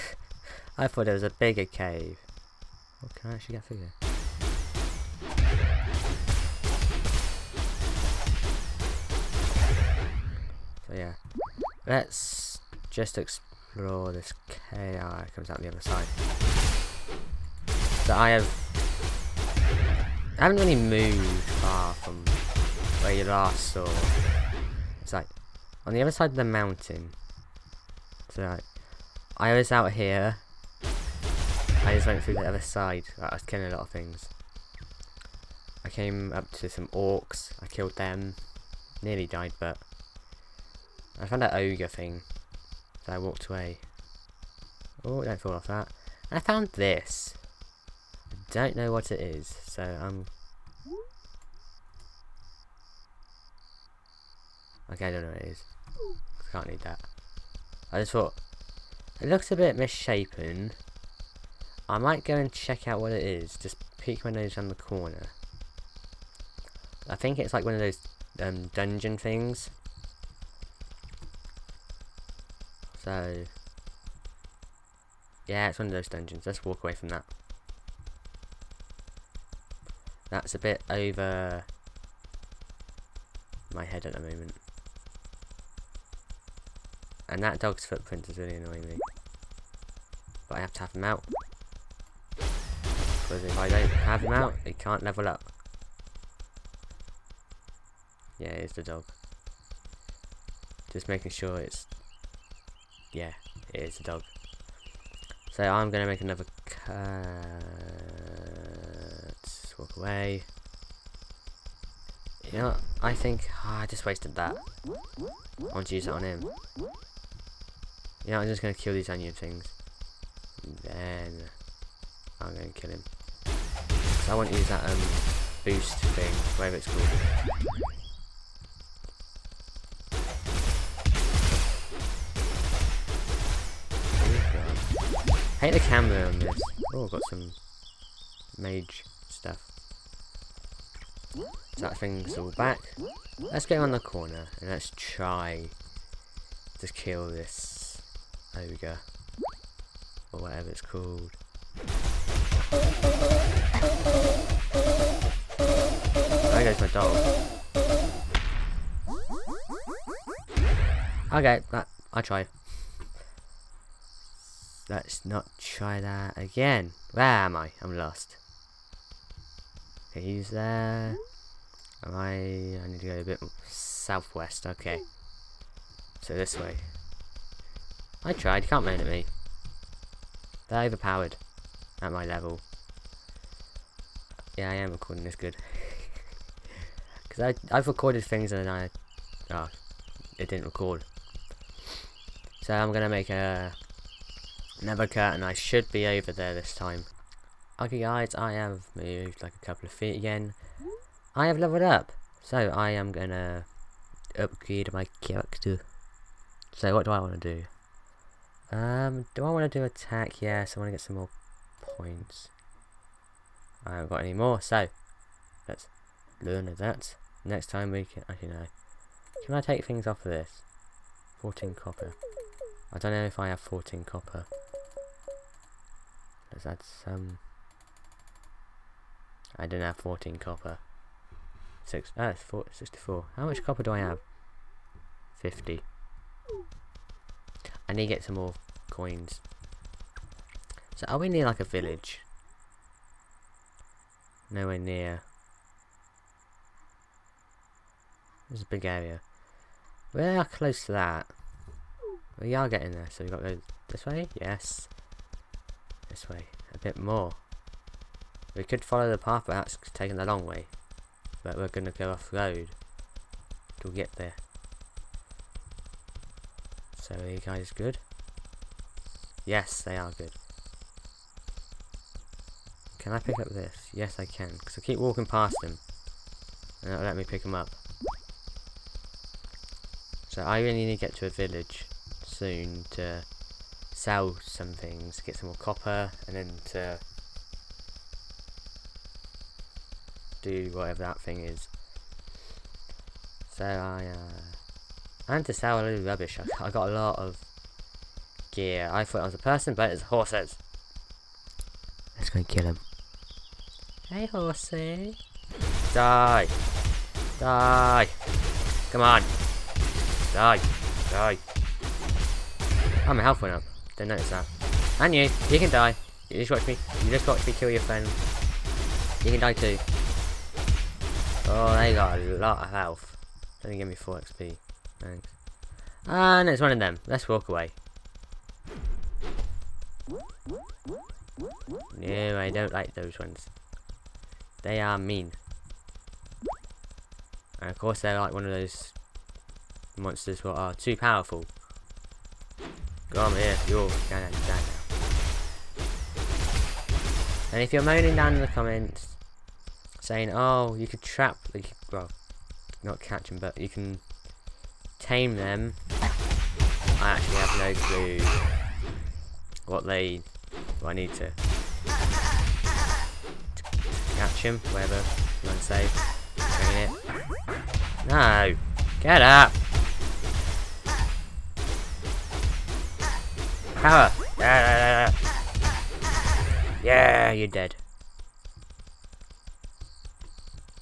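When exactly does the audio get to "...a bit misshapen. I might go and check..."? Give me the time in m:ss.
0:59.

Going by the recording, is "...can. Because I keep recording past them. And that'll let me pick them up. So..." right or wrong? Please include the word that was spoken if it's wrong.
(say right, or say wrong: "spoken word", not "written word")
wrong: "walking", not "recording".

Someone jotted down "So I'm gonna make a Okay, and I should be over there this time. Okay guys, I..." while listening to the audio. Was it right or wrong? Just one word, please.
wrong.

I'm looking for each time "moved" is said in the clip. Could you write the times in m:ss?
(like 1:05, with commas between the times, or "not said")
0:20, 3:18.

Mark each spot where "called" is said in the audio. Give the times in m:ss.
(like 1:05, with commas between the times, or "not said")
2:06, 2:30.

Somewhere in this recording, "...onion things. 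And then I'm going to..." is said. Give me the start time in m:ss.
1:59.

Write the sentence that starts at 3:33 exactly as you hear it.
I haven't got any more, so let's learn that.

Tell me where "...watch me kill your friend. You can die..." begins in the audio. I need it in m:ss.
5:17.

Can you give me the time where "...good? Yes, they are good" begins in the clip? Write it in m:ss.
4:27.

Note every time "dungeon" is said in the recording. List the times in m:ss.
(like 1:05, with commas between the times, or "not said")
1:08, 1:16.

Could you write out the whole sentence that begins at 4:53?
So I, uh, and to sell a little rubbish.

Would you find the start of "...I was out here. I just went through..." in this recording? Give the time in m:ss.
0:29.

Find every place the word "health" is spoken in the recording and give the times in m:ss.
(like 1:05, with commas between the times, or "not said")
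5:13, 5:22.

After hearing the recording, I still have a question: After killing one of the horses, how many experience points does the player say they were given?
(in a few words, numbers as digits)
4 XP.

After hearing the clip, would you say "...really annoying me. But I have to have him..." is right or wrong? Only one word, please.
right.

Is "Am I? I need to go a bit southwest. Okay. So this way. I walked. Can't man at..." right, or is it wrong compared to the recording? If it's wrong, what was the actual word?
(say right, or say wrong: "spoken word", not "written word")
wrong: "tried", not "walked".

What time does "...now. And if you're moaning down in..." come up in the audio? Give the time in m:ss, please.
5:44.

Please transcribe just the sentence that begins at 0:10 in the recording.
yeah, let's just explore this KI.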